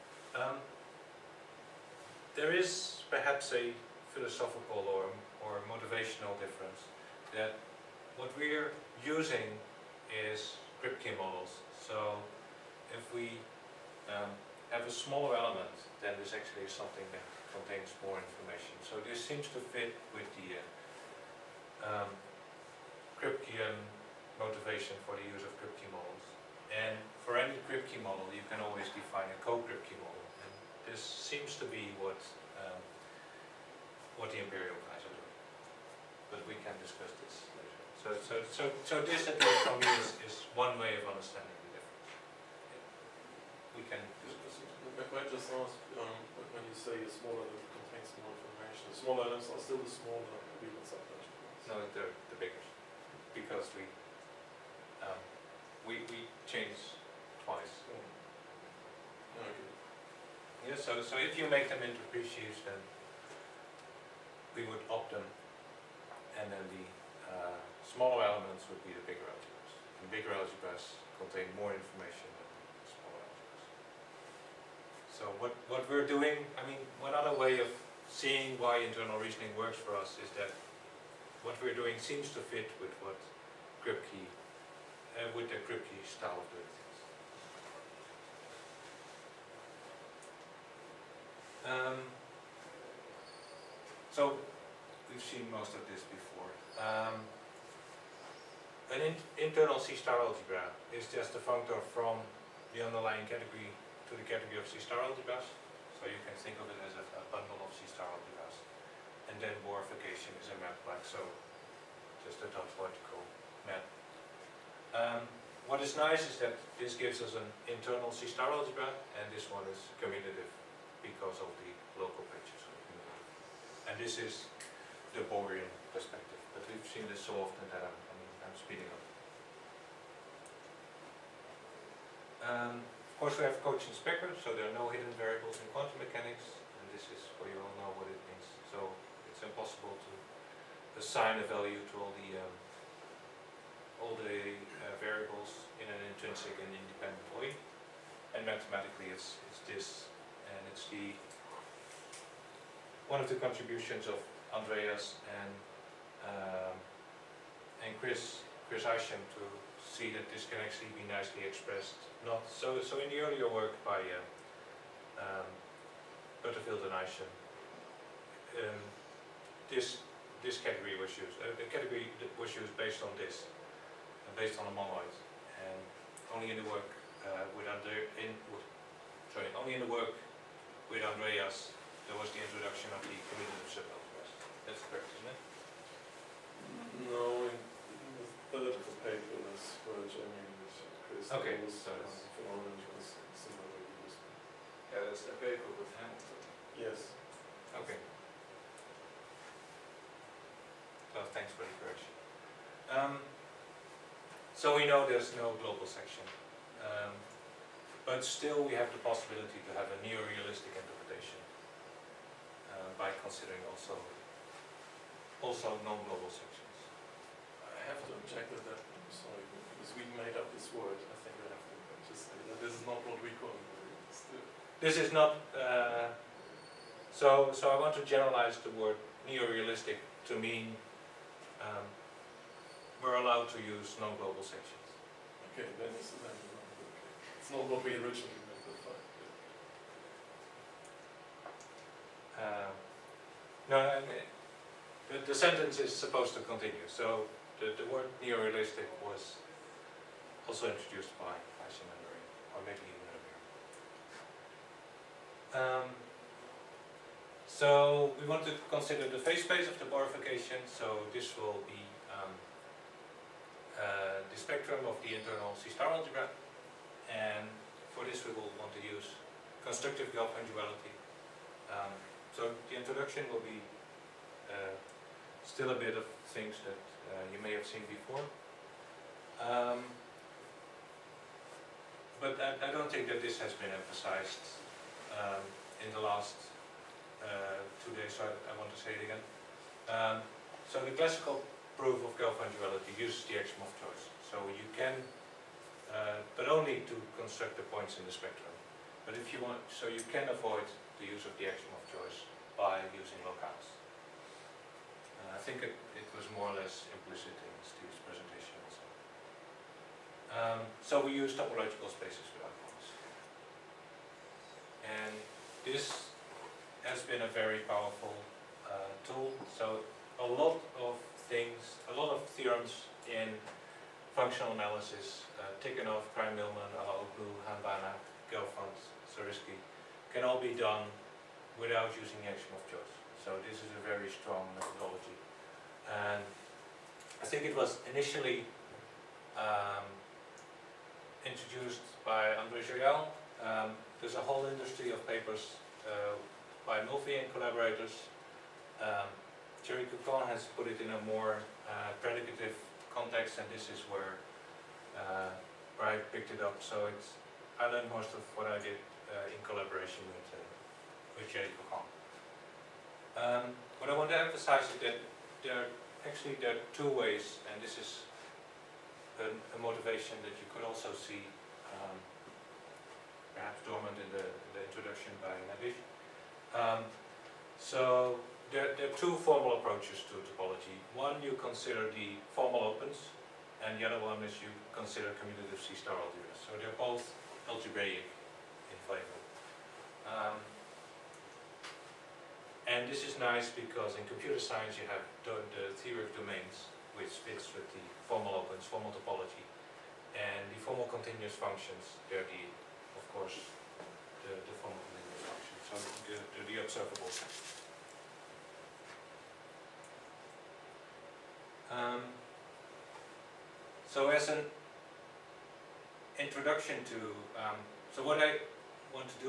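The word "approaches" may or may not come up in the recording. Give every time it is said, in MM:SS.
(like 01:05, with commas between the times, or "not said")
06:19.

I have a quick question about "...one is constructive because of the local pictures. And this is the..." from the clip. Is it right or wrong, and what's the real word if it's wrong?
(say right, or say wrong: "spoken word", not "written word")
wrong: "commutative", not "constructive".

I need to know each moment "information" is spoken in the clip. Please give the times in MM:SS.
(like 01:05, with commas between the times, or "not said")
00:18, 00:48, 01:11.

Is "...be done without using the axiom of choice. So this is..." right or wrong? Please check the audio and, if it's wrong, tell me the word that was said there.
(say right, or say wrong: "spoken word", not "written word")
right.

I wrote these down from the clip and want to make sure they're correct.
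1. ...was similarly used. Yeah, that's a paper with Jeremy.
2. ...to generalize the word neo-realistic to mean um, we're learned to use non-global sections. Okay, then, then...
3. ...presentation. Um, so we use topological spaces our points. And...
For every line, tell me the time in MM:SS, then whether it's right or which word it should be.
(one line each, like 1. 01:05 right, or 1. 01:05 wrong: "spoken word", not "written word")
1. 03:12 wrong: "Hamilton", not "Jeremy"
2. 03:47 wrong: "allowed", not "learned"
3. 05:08 right.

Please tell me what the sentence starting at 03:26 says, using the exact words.
Um, but still we have the possibility to have a neo-realistic interpretation uh, by considering also also non-global sections.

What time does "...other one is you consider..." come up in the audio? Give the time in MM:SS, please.
06:23.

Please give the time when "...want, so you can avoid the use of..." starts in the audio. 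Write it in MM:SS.
04:59.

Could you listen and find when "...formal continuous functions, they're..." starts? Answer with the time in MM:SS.
06:40.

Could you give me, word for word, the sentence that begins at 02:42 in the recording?
Not so so in the earlier work by uh, um, Butterfield and Isham, um, this this category was used.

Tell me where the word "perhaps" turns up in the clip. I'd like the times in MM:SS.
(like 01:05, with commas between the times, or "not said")
00:03, 06:13.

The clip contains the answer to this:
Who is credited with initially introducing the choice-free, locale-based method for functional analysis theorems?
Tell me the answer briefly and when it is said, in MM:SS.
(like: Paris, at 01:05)
André Joyal, at 05:42.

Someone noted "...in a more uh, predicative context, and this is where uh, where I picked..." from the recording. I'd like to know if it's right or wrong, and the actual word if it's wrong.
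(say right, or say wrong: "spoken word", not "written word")
right.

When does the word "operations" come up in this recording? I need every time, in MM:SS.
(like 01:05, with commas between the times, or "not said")
not said.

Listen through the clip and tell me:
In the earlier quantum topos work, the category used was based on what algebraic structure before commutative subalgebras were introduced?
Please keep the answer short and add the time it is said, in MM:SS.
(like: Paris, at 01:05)
a monoid, at 02:54.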